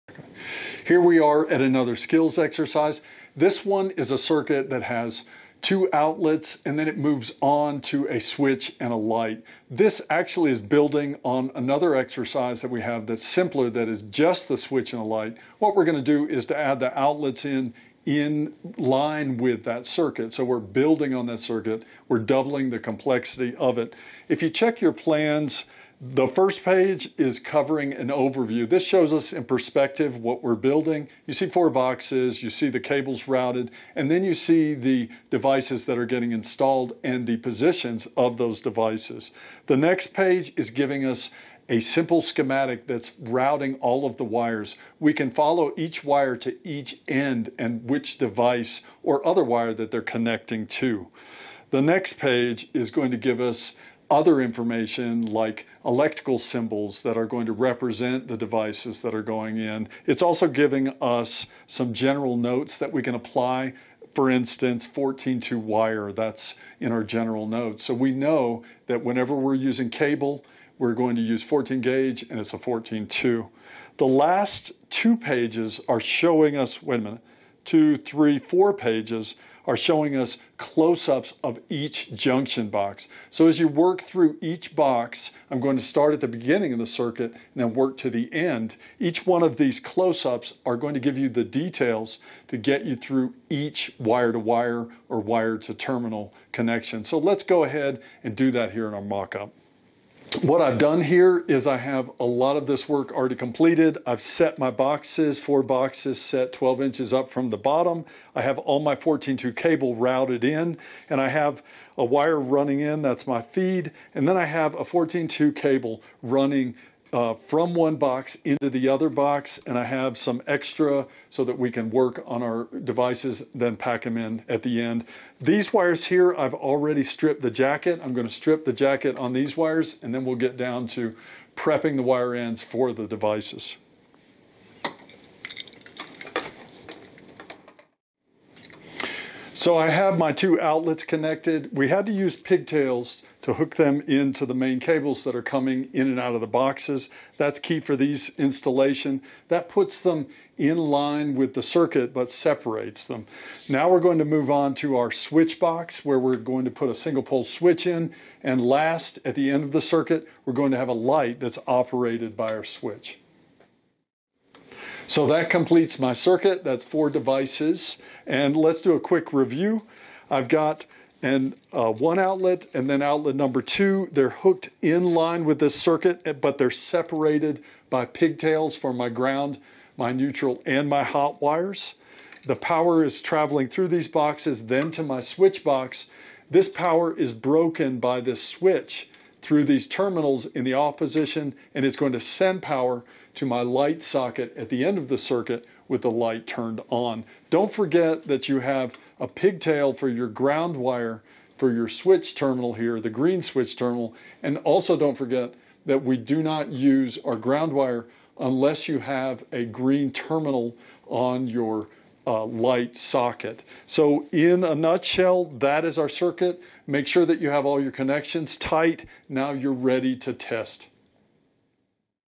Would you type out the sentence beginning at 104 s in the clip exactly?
I've set my boxes, four boxes set 12 inches up from the bottom.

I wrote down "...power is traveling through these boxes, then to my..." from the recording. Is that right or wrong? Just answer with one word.
right.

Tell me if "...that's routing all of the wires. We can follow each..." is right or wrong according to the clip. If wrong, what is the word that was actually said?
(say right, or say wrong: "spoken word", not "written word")
right.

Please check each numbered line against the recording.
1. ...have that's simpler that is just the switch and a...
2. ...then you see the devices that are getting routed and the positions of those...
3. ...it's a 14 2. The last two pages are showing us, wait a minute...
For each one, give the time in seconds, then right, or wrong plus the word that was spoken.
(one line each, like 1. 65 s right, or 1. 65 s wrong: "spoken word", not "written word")
1. 12 s right
2. 34 s wrong: "installed", not "routed"
3. 72 s right.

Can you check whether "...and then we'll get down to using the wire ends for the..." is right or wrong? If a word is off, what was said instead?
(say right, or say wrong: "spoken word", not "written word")
wrong: "prepping", not "using".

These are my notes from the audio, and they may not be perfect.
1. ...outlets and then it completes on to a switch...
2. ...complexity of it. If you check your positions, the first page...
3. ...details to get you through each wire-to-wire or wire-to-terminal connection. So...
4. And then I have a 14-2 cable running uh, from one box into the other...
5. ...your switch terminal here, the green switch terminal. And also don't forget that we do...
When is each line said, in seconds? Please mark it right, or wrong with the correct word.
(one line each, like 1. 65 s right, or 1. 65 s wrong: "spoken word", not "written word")
1. 5 s wrong: "moves", not "completes"
2. 22 s wrong: "plans", not "positions"
3. 91 s right
4. 114 s right
5. 201 s right.